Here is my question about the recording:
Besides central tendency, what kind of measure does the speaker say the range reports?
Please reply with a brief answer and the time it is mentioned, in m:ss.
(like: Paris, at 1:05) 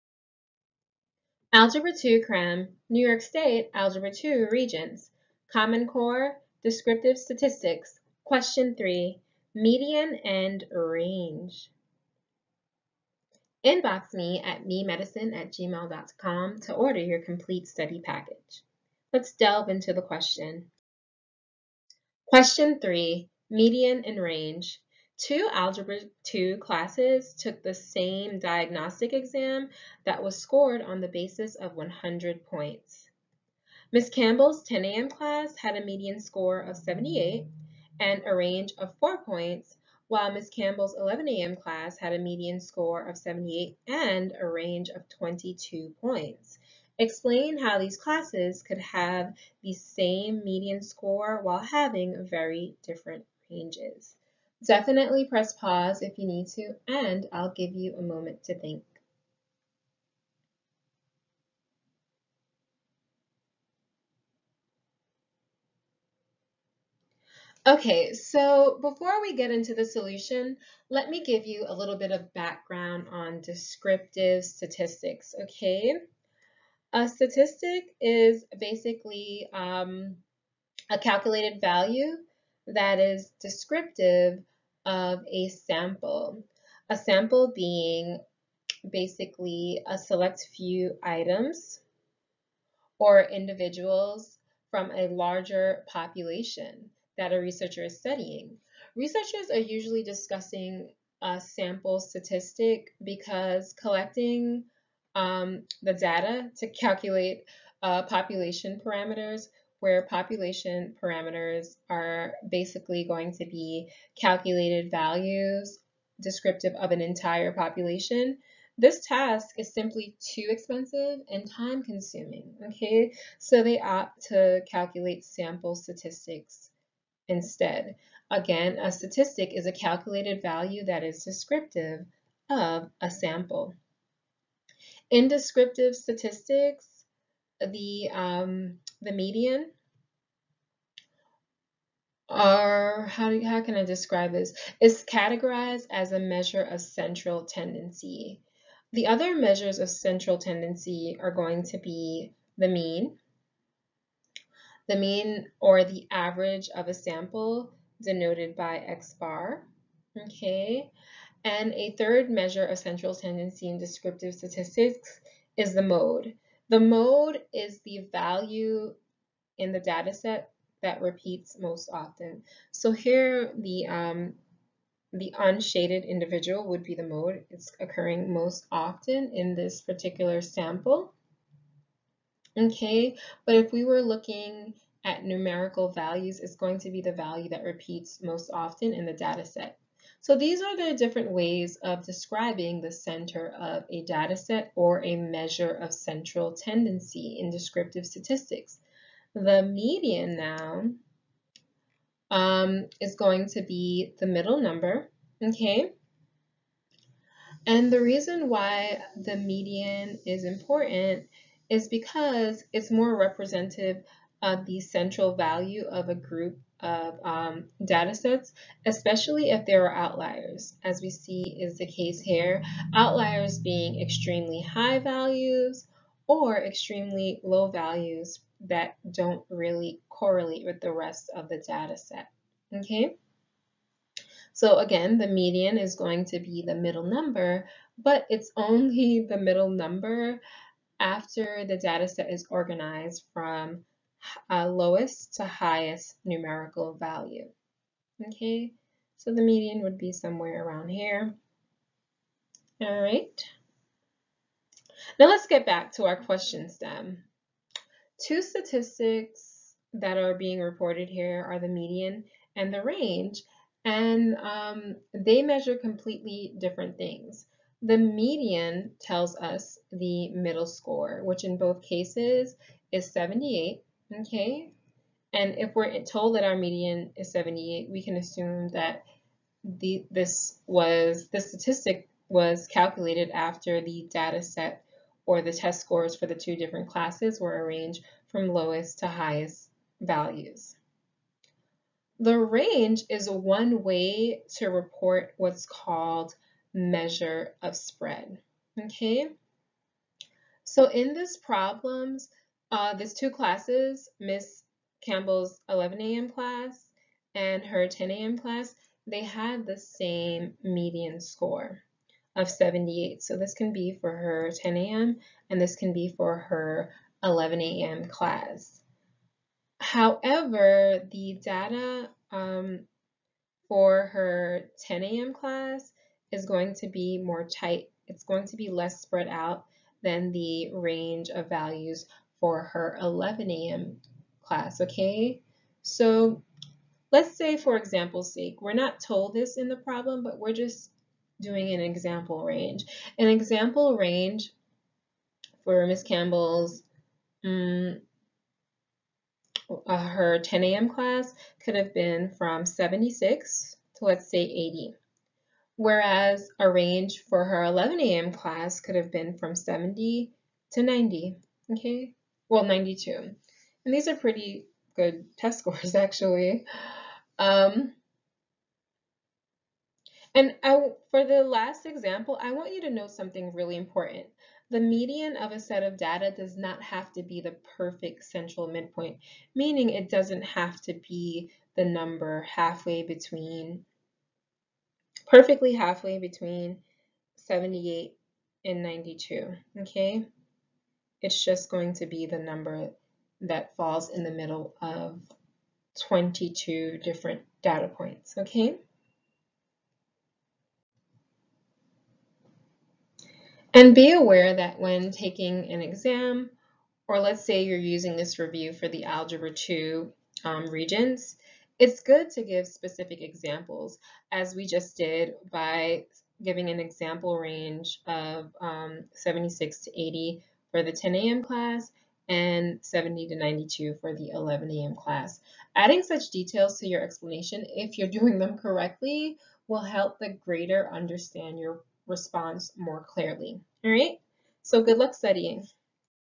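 measure of spread, at 4:56.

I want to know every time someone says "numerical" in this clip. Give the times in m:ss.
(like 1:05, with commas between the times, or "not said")
3:05, 4:06.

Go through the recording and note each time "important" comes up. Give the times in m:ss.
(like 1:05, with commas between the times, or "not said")
3:30, 6:13.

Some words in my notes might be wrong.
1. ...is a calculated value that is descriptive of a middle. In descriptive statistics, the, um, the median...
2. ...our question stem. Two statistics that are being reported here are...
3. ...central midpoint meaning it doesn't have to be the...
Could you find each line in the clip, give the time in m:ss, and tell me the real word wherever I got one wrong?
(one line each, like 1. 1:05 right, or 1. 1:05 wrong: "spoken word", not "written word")
1. 2:09 wrong: "sample", not "middle"
2. 4:16 right
3. 6:18 right.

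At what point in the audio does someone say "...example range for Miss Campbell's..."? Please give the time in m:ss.
5:43.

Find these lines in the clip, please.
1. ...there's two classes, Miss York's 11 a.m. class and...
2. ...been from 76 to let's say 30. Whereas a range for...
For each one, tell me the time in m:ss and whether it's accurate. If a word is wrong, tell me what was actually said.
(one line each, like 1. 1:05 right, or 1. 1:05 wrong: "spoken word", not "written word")
1. 5:02 wrong: "Campbell", not "York"
2. 5:51 wrong: "80", not "30".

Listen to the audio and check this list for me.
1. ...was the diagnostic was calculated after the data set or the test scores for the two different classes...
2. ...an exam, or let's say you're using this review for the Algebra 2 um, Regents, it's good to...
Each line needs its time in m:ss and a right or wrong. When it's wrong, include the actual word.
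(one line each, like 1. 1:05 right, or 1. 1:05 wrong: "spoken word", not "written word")
1. 4:40 wrong: "statistic", not "diagnostic"
2. 6:45 right.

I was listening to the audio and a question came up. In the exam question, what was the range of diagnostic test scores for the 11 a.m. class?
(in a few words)
22 points.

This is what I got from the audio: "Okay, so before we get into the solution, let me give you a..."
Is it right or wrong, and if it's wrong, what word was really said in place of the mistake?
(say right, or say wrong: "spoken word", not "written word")
right.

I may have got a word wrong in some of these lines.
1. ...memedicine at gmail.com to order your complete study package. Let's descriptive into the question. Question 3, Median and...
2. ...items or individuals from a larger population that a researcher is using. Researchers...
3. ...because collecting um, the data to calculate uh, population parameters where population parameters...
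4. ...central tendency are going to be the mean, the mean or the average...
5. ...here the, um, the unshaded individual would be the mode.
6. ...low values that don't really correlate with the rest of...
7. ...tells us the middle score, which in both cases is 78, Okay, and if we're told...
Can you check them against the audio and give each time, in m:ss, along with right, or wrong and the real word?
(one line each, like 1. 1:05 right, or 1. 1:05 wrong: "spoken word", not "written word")
1. 0:14 wrong: "delve", not "descriptive"
2. 1:31 wrong: "studying", not "using"
3. 1:43 right
4. 2:29 right
5. 2:52 right
6. 3:47 right
7. 4:29 right.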